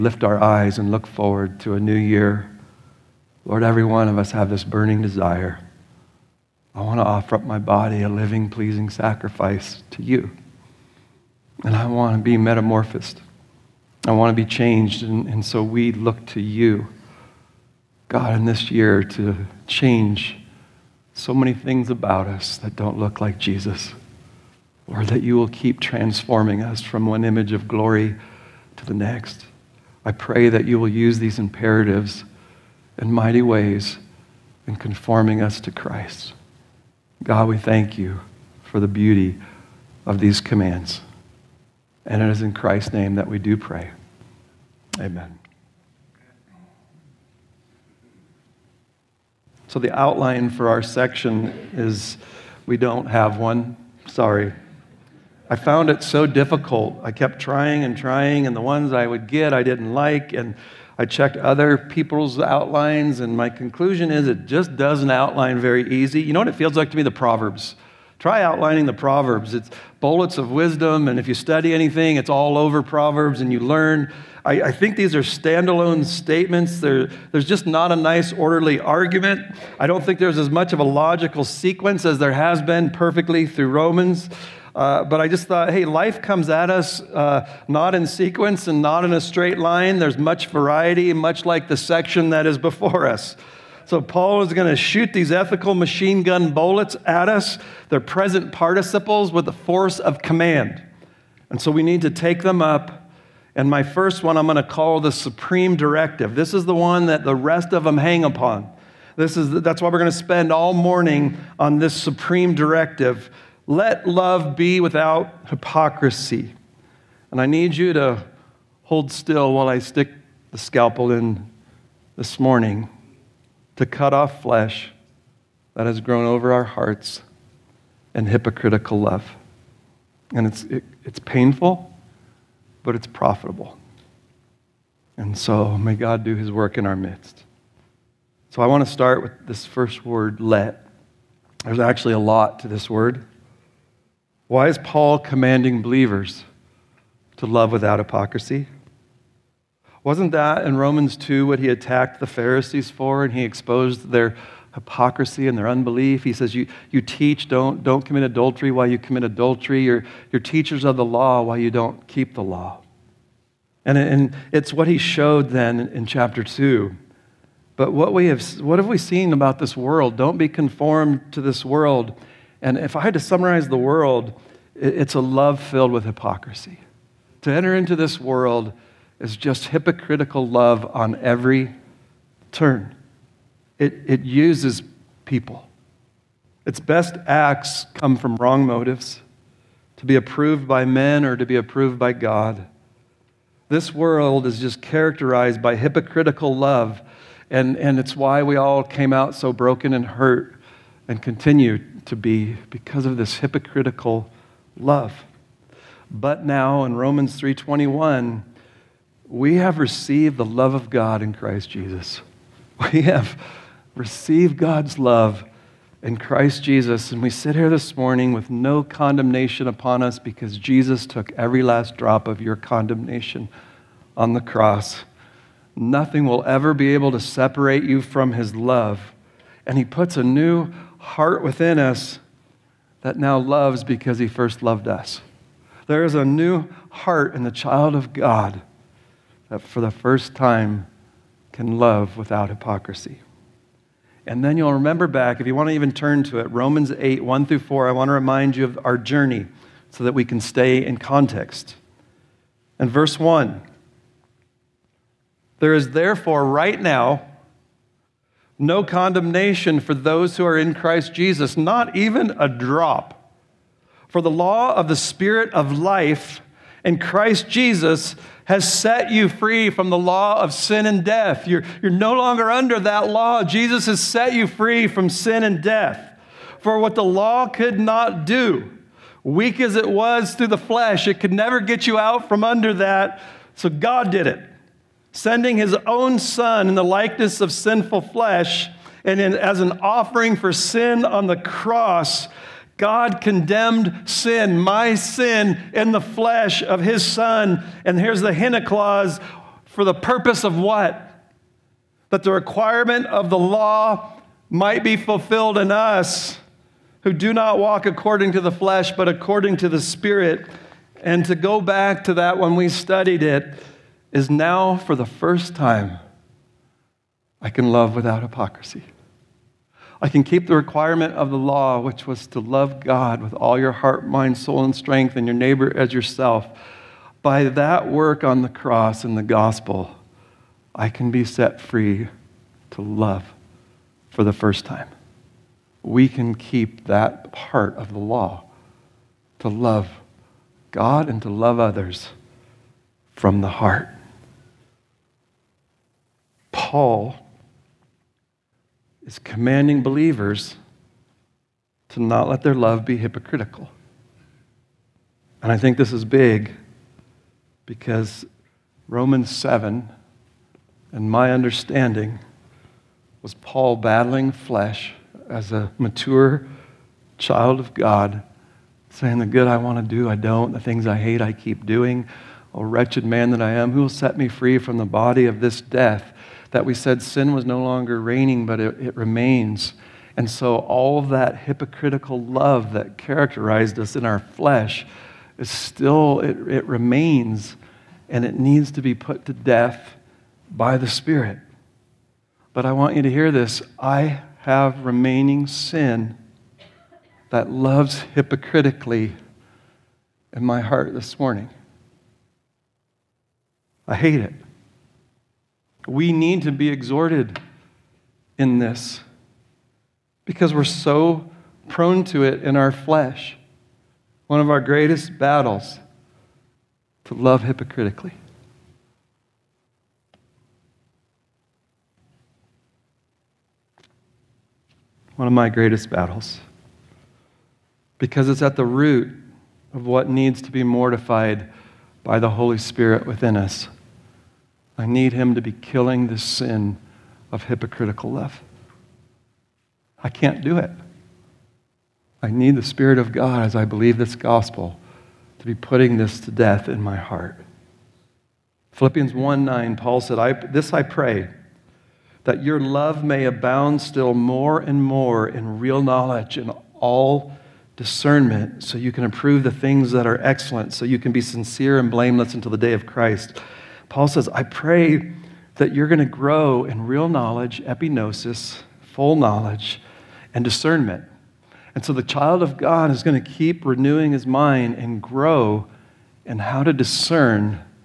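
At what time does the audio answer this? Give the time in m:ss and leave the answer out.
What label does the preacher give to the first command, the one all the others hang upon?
1:44.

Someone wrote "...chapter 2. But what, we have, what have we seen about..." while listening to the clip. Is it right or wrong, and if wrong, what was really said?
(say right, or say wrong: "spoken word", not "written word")
right.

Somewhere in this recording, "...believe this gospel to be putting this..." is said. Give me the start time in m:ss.
7:23.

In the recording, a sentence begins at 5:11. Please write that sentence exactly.
And to go back to that when we studied it, is now for the first time I can love without hypocrisy.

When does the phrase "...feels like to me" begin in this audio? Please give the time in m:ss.
1:06.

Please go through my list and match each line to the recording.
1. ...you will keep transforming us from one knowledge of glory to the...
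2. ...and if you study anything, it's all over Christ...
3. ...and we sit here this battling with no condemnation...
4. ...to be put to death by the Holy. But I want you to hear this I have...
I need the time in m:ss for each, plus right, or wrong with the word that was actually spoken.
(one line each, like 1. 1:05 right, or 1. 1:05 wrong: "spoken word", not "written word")
1. 0:25 wrong: "image", not "knowledge"
2. 1:11 wrong: "Proverbs", not "Christ"
3. 3:37 wrong: "morning", not "battling"
4. 6:28 wrong: "Spirit", not "Holy".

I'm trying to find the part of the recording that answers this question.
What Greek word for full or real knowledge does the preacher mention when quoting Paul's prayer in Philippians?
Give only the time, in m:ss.
7:47.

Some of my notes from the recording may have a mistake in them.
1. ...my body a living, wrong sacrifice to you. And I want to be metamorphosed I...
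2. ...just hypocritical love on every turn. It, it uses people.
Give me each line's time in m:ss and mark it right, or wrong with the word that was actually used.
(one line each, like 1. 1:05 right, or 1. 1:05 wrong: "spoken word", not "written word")
1. 0:07 wrong: "pleasing", not "wrong"
2. 2:59 right.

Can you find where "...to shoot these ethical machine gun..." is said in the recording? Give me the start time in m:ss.
1:34.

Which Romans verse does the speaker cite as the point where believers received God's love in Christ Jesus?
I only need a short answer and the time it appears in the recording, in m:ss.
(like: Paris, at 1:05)
Romans 3:21, at 3:26.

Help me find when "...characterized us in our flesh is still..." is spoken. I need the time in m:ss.
6:22.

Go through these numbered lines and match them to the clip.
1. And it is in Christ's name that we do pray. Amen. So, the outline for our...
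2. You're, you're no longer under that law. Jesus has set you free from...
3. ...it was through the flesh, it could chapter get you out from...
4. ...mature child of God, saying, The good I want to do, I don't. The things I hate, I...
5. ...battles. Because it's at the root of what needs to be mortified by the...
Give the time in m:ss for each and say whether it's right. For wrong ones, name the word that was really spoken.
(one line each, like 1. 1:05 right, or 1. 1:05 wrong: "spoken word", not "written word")
1. 0:42 right
2. 4:31 right
3. 4:39 wrong: "never", not "chapter"
4. 6:05 right
5. 7:05 right.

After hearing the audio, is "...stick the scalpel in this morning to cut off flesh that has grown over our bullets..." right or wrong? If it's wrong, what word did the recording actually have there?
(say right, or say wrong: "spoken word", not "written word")
wrong: "hearts", not "bullets".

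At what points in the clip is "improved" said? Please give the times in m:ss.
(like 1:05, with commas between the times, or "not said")
not said.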